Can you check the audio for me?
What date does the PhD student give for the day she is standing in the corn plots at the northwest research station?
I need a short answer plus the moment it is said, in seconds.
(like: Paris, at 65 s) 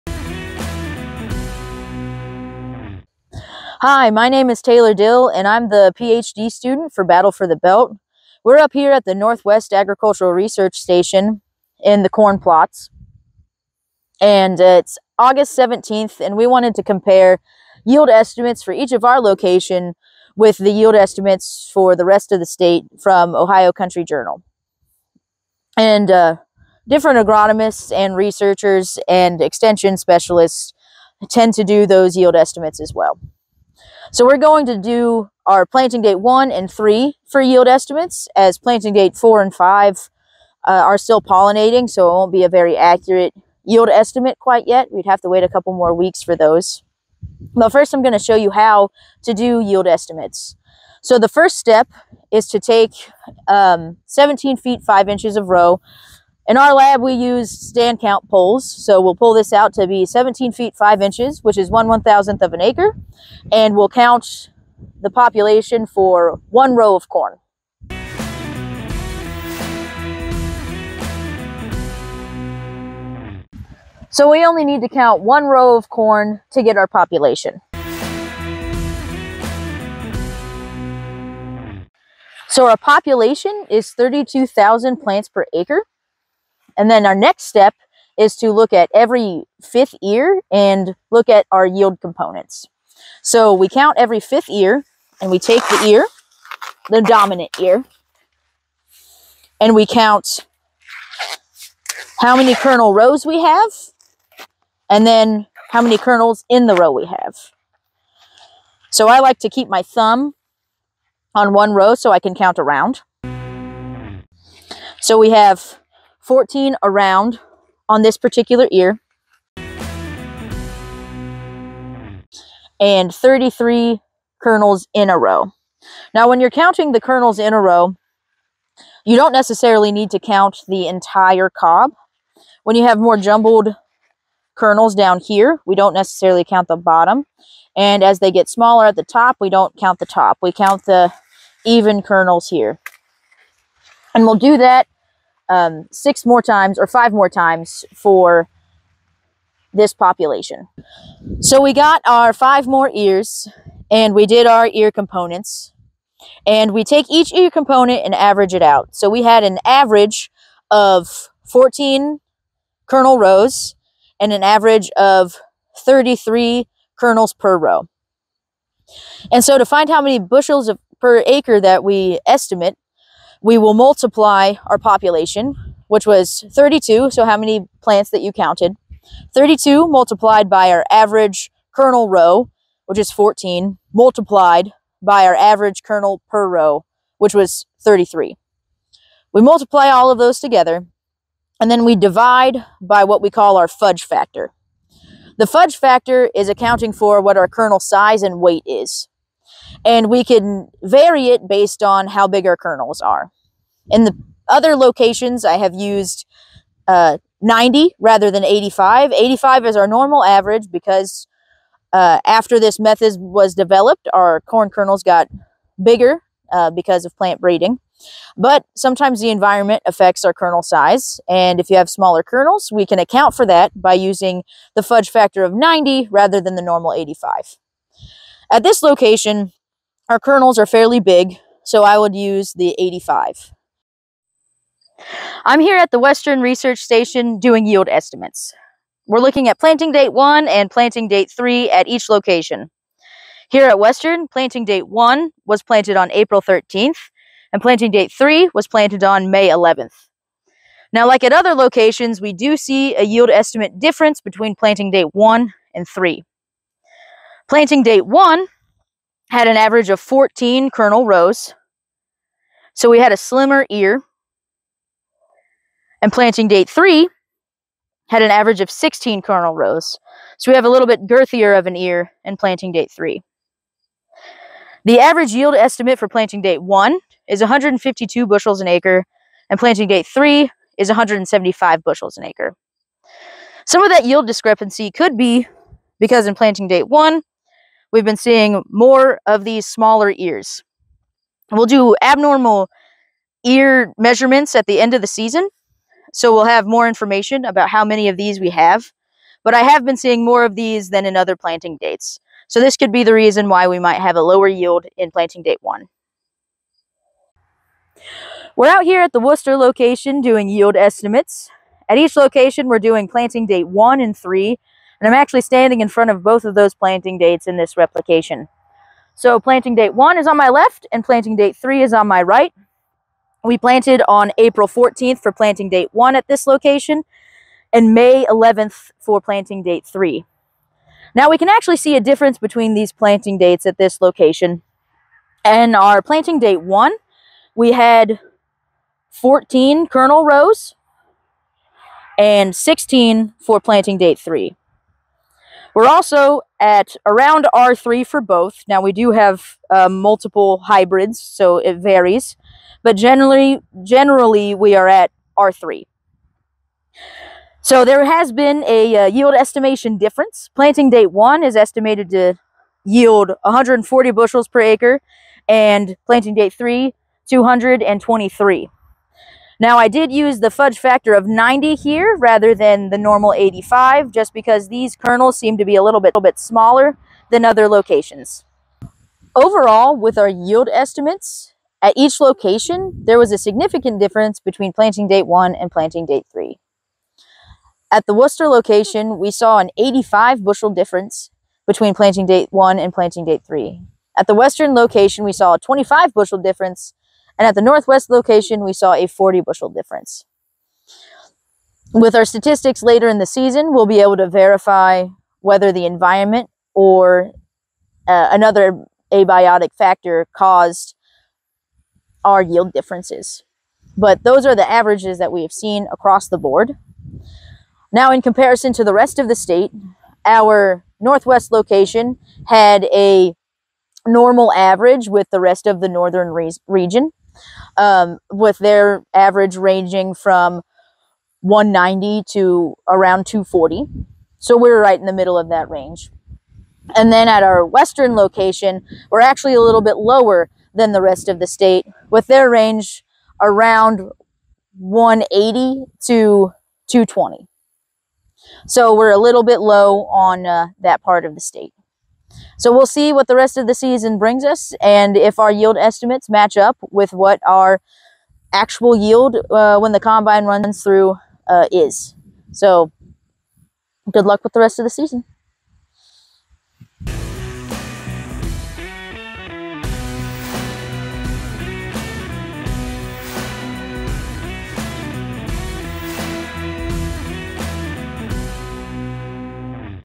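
August 17th, at 15 s.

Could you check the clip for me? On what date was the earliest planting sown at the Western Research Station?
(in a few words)
April 13th.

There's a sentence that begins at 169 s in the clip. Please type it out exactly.
And so to find how many bushels of, per acre that we estimate, we will multiply our population, which was 32.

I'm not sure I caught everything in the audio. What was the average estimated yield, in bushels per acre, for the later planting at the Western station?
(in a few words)
175.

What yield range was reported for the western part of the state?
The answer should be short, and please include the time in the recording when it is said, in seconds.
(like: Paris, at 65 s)
180 to 220, at 444 s.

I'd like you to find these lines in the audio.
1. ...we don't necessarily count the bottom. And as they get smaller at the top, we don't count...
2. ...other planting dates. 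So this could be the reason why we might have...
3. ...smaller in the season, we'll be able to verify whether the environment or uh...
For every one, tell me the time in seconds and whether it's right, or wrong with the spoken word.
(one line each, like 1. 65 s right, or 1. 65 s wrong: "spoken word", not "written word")
1. 135 s right
2. 301 s right
3. 402 s wrong: "later", not "smaller".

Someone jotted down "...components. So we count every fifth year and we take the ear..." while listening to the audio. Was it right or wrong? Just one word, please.
right.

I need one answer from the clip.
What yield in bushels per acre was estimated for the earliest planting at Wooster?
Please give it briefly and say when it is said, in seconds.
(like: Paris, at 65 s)
140, at 363 s.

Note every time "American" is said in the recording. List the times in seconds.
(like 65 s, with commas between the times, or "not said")
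not said.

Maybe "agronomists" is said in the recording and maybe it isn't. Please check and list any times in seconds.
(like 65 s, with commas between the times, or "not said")
27 s.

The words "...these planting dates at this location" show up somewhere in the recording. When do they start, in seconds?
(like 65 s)
332 s.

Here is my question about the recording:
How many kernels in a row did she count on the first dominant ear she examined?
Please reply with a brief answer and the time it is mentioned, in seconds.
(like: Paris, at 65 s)
33, at 123 s.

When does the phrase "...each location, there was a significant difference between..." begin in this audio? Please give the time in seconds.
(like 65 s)
381 s.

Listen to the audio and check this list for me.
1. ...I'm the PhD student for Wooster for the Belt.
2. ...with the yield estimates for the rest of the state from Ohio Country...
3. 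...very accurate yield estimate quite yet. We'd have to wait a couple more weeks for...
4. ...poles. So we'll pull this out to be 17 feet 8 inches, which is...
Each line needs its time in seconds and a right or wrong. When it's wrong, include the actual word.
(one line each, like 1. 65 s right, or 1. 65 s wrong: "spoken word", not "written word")
1. 5 s wrong: "Battle", not "Wooster"
2. 20 s right
3. 42 s right
4. 58 s wrong: "5", not "8".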